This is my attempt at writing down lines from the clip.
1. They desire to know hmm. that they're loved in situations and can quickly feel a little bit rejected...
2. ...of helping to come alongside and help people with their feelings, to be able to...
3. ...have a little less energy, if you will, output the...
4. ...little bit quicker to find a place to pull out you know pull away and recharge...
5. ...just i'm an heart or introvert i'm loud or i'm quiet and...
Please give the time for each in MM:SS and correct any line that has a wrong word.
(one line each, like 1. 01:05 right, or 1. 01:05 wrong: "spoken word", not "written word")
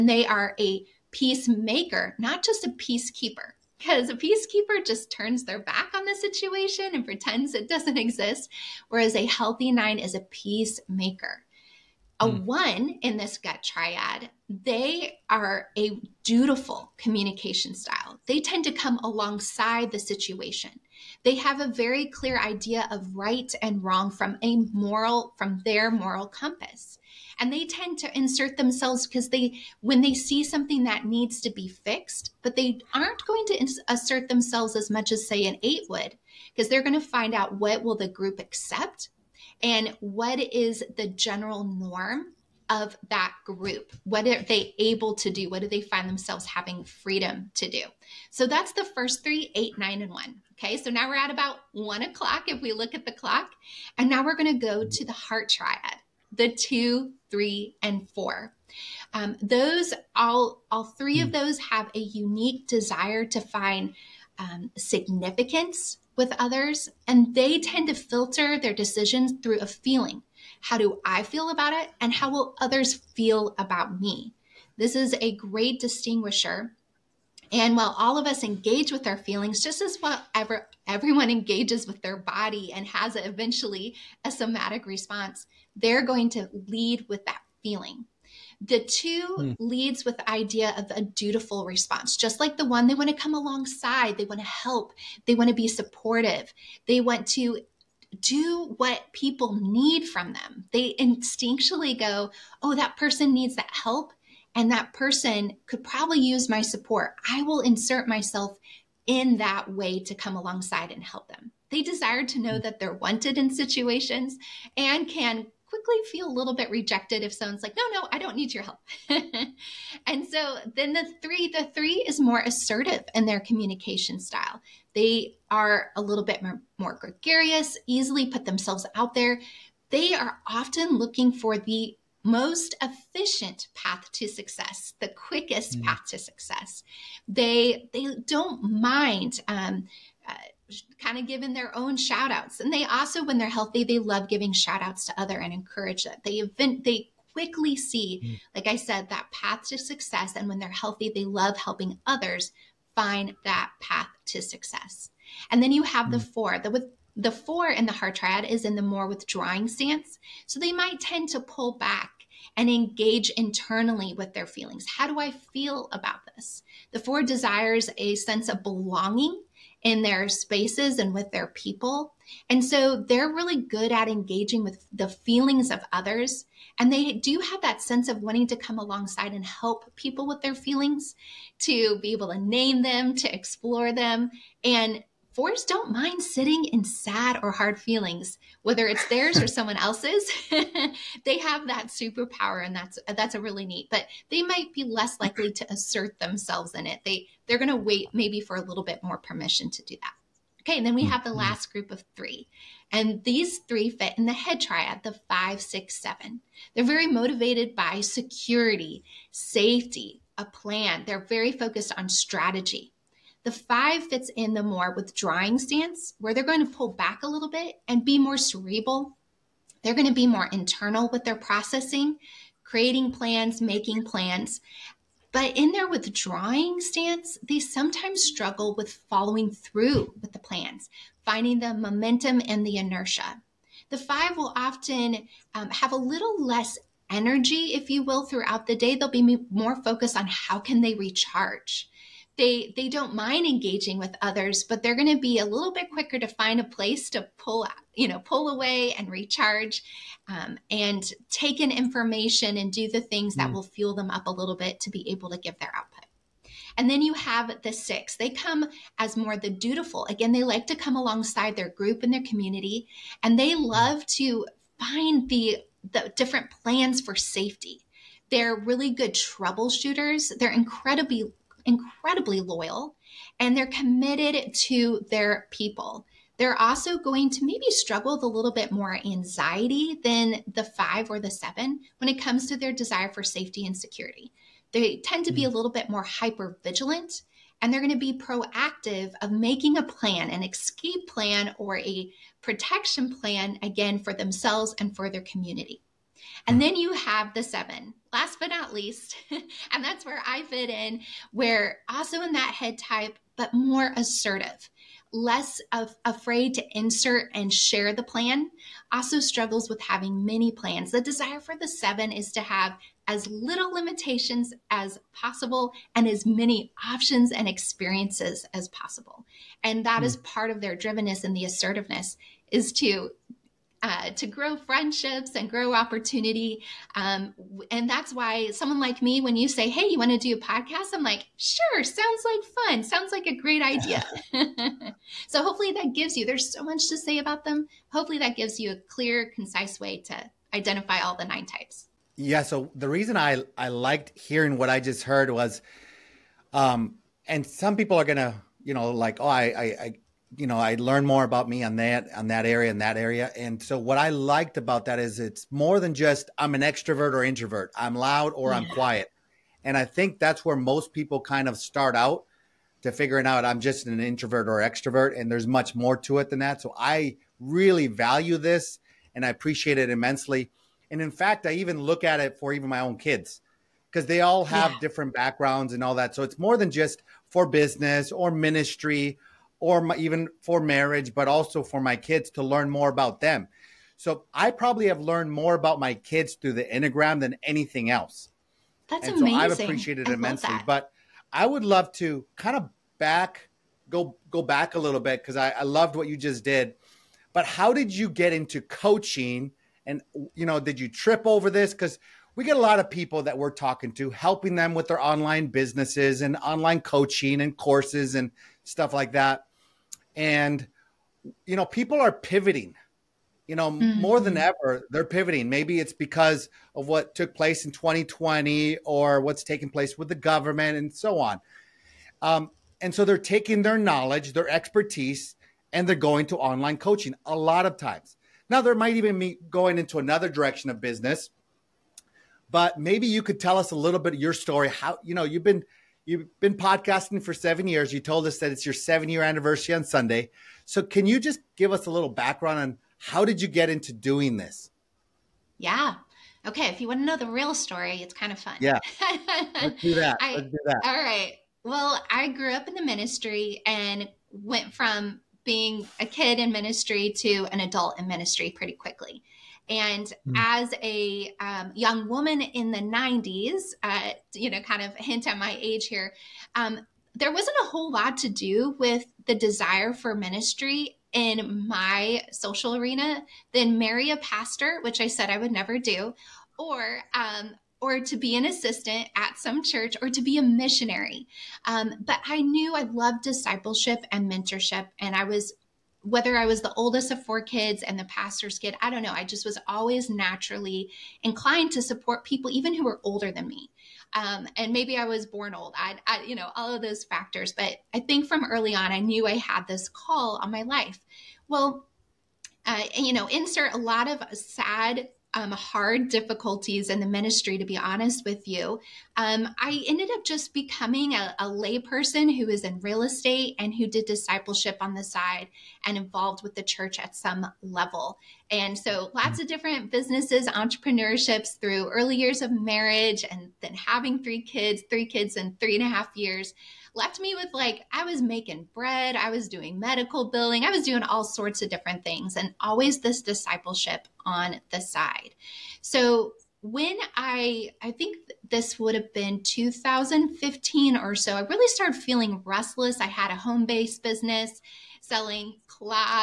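1. 01:51 wrong: "wanted", not "loved"
2. 02:58 wrong: "wanting", not "helping"
3. 03:55 wrong: "throughout", not "output"
4. 04:05 right
5. 05:55 wrong: "extrovert", not "heart".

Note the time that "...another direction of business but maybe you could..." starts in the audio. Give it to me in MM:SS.
07:09.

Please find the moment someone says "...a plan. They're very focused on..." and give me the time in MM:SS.
03:30.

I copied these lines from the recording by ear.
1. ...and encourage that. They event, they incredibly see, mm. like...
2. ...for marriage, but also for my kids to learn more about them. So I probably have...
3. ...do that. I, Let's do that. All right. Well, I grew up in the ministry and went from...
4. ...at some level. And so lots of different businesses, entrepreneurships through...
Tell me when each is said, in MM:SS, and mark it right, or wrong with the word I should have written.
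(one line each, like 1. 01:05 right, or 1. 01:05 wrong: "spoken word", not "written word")
1. 02:25 wrong: "quickly", not "incredibly"
2. 06:20 right
3. 07:29 right
4. 08:36 right.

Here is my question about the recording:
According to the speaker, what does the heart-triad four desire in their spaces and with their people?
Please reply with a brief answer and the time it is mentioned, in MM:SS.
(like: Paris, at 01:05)
A sense of belonging, at 02:47.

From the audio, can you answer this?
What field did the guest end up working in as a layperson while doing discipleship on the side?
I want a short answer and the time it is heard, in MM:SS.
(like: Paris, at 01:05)
Real estate, at 08:32.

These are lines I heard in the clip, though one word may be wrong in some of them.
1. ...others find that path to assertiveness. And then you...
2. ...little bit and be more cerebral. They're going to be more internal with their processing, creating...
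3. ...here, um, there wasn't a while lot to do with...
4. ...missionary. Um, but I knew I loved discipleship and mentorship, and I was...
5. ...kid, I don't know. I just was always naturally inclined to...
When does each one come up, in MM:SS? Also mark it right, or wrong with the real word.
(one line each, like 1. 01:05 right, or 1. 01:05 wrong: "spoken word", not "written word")
1. 02:32 wrong: "success", not "assertiveness"
2. 03:37 right
3. 07:45 wrong: "whole", not "while"
4. 08:00 right
5. 08:08 right.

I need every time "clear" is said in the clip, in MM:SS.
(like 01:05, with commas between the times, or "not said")
00:22, 05:38.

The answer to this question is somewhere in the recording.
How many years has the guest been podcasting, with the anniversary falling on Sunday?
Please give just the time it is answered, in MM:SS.
07:17.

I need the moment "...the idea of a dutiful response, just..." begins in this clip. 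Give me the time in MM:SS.
01:30.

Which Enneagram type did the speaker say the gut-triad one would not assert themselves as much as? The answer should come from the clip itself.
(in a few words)
8.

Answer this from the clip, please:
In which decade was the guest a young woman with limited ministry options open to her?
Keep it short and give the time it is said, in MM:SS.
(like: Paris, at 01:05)
The 90s, at 07:42.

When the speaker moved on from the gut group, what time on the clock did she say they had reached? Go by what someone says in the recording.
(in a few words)
1 o'clock.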